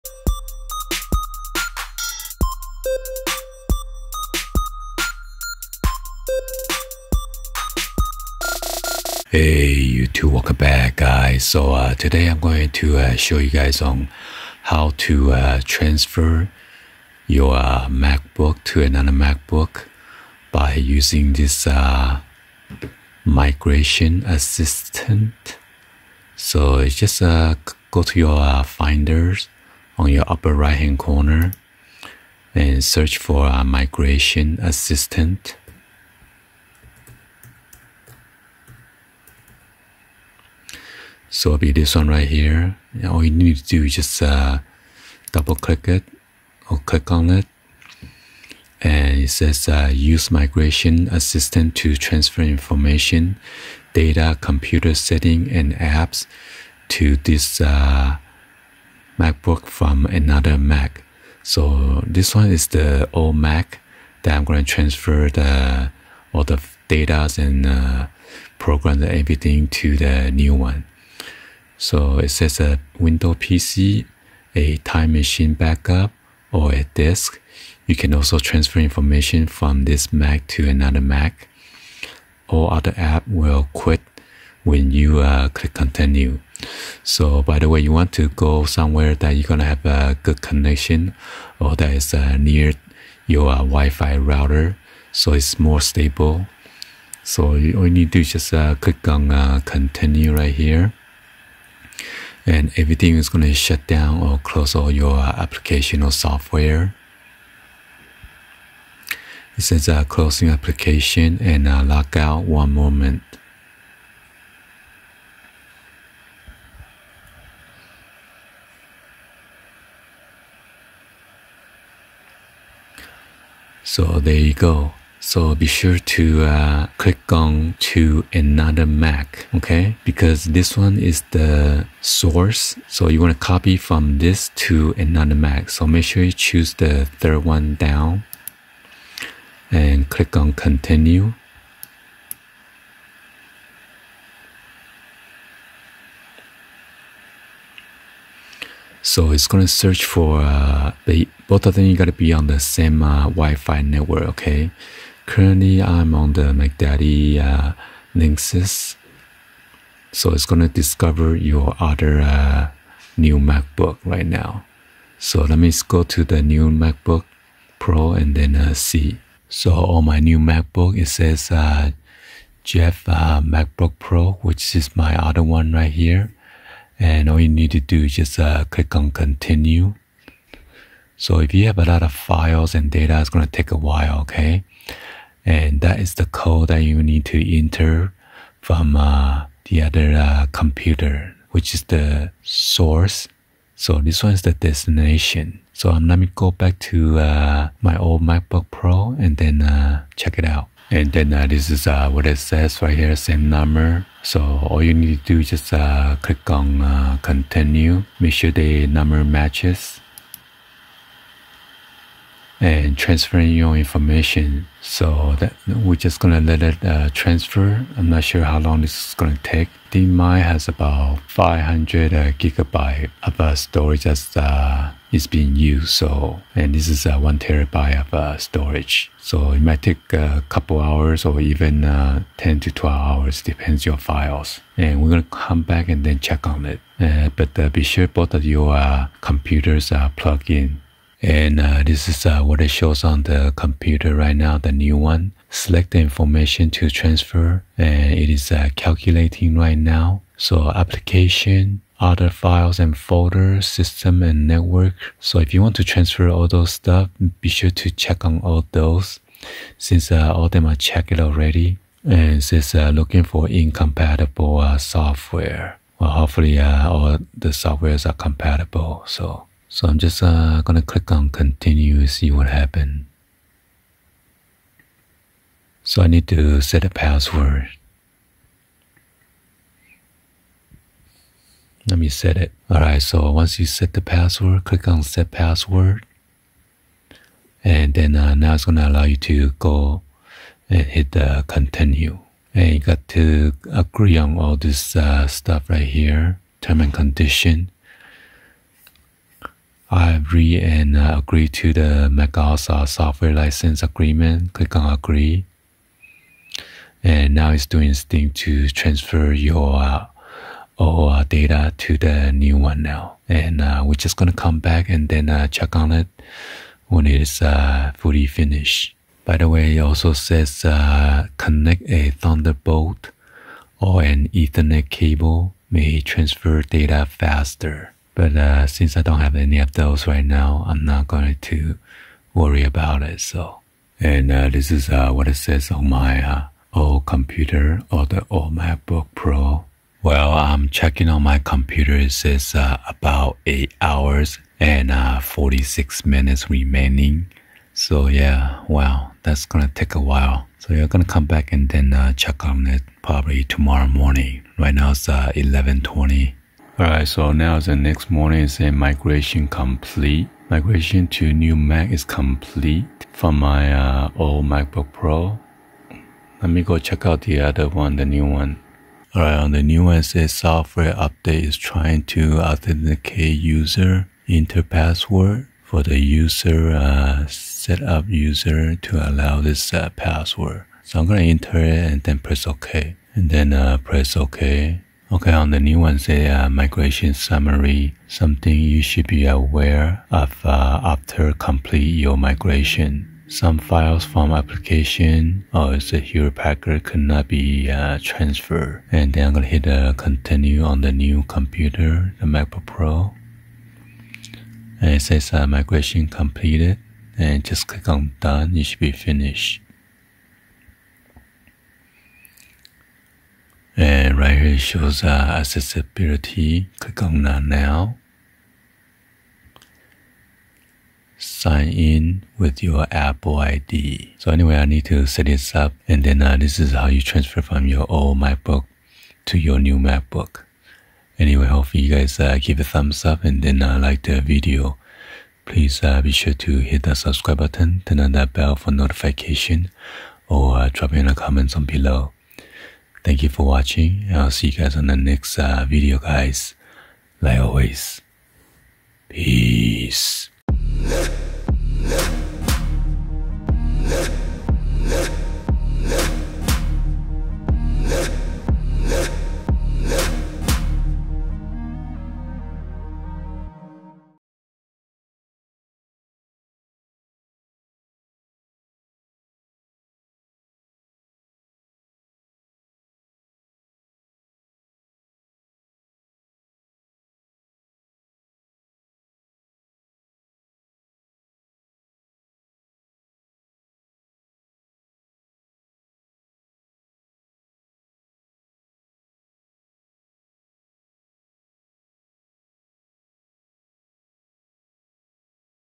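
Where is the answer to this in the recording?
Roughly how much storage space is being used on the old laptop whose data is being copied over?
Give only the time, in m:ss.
3:41.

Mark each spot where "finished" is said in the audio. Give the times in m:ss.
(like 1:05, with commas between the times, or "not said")
5:18, 6:48.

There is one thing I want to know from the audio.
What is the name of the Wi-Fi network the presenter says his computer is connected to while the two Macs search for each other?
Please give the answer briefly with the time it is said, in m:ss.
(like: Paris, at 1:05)
Mac Daddy Linksys, at 2:36.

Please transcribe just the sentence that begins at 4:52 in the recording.
And you got to agree on all this uh, stuff right here, term and condition.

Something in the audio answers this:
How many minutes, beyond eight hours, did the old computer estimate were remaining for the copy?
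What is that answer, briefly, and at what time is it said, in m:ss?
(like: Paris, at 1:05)
46, at 5:45.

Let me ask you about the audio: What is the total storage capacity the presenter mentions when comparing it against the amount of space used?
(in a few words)
1 terabyte.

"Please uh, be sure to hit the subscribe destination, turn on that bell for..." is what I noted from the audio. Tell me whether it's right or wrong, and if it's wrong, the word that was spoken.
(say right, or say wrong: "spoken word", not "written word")
wrong: "button", not "destination".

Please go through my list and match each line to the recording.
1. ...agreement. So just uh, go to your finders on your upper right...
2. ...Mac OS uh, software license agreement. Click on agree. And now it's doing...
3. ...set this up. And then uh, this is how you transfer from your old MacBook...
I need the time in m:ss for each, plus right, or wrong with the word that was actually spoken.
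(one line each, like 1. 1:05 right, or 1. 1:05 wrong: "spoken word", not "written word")
1. 0:24 wrong: "assistant", not "agreement"
2. 5:02 right
3. 7:05 right.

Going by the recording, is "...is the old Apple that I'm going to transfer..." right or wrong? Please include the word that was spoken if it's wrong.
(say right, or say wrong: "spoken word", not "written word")
wrong: "Mac", not "Apple".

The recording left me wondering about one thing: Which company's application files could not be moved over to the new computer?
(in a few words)
Hewlett Packard.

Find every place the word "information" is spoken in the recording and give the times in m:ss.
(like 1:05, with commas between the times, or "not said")
0:52, 1:18, 3:33, 4:05.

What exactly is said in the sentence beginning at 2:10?
Because this one is the source.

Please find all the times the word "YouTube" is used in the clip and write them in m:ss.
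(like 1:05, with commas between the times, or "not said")
0:09.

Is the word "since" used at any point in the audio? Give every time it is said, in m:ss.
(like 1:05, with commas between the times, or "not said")
4:19, 5:28.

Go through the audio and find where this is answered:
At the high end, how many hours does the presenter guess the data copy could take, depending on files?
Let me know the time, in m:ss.
3:52.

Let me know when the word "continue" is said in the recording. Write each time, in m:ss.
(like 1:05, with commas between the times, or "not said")
1:25, 1:39, 2:20, 2:59, 3:27, 4:31, 4:51, 6:39.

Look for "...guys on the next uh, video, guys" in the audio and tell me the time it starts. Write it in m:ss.
7:24.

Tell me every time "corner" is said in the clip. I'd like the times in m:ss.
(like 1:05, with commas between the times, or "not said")
0:30.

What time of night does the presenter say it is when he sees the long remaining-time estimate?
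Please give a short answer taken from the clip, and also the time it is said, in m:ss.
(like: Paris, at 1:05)
11:20, at 5:55.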